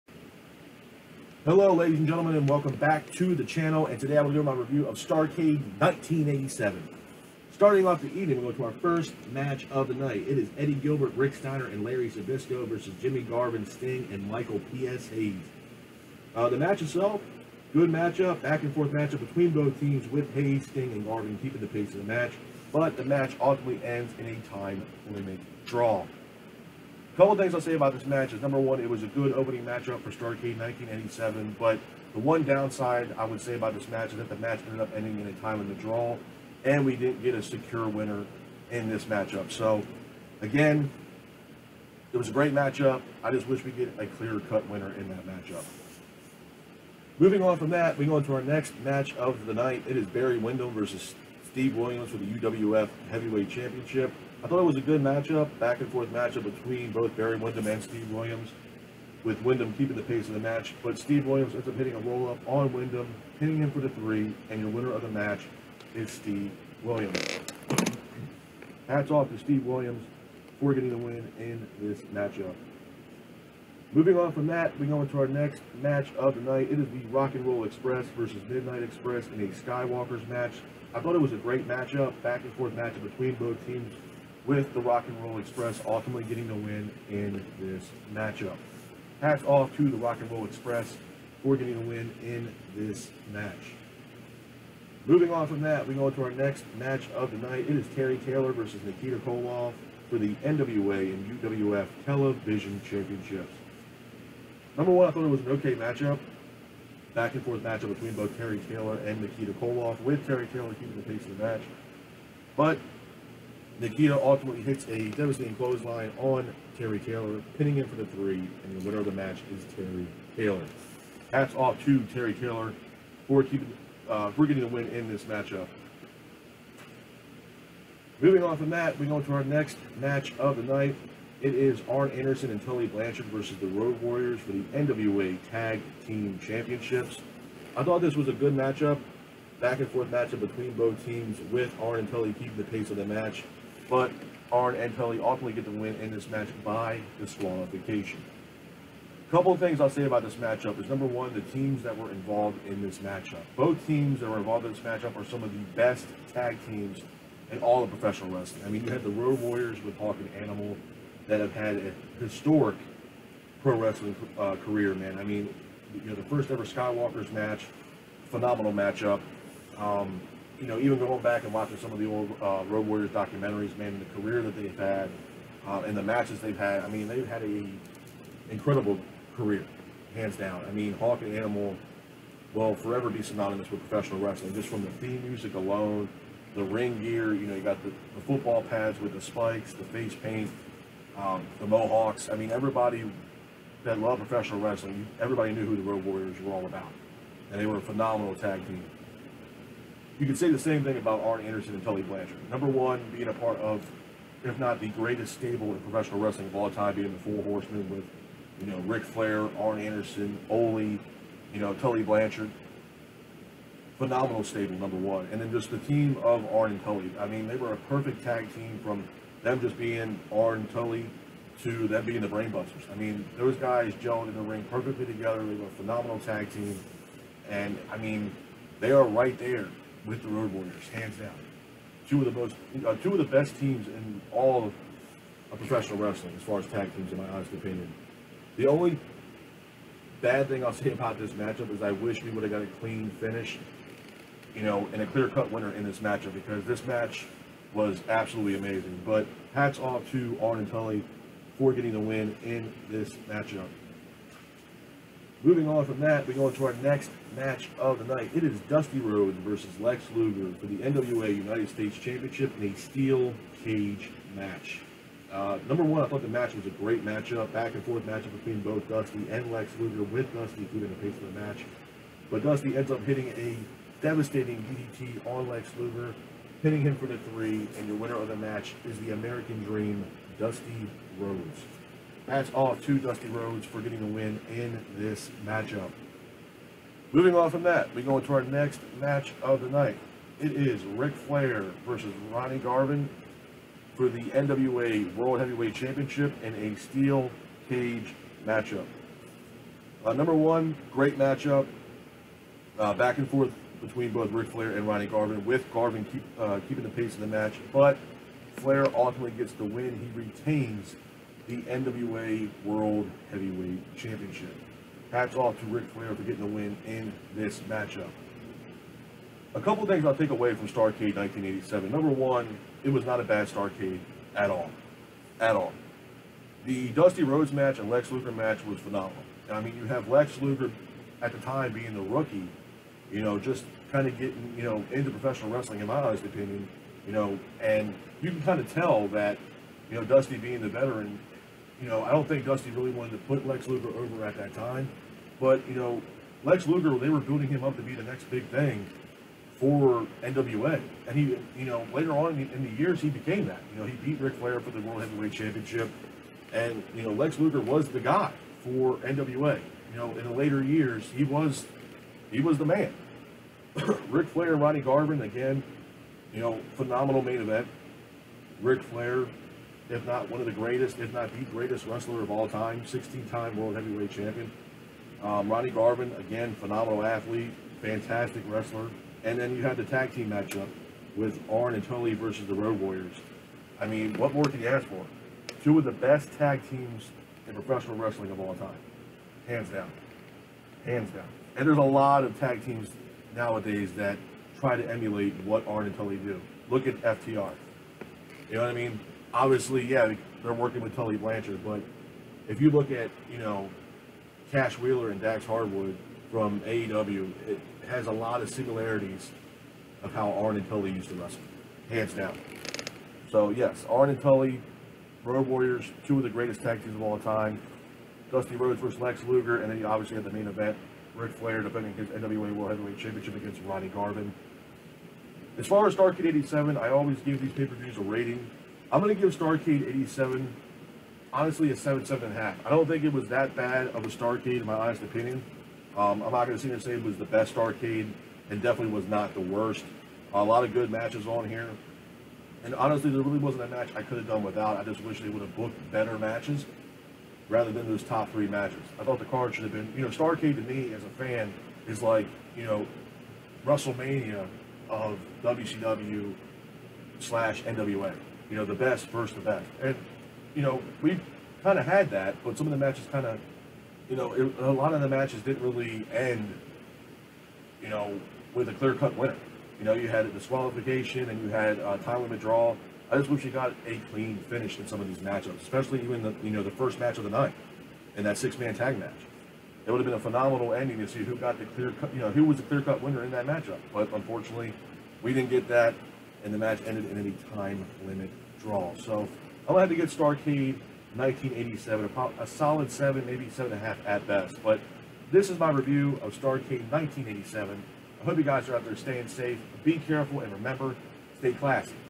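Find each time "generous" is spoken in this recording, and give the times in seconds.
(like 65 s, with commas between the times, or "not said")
not said.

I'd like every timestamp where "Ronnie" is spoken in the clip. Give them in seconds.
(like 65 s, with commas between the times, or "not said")
292 s, 304 s, 364 s, 375 s, 423 s.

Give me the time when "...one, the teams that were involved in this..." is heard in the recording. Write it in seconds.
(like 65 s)
151 s.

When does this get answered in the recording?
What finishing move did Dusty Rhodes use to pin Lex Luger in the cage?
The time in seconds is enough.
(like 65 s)
274 s.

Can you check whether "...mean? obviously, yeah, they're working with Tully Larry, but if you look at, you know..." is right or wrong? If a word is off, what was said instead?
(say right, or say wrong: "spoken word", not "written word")
wrong: "Blanchard", not "Larry".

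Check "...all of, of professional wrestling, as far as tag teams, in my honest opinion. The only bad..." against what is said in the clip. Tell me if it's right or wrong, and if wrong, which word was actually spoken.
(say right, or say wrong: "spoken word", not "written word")
right.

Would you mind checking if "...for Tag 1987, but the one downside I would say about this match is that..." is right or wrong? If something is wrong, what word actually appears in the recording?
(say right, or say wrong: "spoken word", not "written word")
wrong: "Starrcade", not "Tag".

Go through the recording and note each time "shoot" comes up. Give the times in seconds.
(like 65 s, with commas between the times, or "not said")
not said.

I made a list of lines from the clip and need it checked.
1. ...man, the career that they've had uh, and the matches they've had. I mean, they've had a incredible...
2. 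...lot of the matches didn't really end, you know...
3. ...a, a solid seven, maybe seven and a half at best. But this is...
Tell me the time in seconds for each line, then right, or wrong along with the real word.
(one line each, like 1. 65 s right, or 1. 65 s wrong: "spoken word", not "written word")
1. 173 s right
2. 464 s right
3. 492 s right.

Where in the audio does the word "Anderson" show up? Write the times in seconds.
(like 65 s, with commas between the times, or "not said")
132 s, 201 s, 209 s.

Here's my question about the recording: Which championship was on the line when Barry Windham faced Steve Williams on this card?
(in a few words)
UWF Heavyweight Championship.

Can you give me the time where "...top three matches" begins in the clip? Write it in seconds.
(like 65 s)
448 s.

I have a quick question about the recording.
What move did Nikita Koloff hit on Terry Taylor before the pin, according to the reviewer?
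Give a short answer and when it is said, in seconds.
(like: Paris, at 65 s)
clothesline, at 115 s.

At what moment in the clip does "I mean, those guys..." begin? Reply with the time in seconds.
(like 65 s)
222 s.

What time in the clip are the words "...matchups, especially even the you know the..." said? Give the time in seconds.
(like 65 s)
475 s.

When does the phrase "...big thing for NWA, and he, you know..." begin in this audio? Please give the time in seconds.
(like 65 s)
348 s.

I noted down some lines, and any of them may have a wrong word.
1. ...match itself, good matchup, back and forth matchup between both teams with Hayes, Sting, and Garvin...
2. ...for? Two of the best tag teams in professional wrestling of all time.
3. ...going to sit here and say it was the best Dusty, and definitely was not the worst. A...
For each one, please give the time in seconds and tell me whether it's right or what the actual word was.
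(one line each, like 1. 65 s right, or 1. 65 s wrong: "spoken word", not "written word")
1. 16 s right
2. 384 s right
3. 436 s wrong: "Starrcade", not "Dusty".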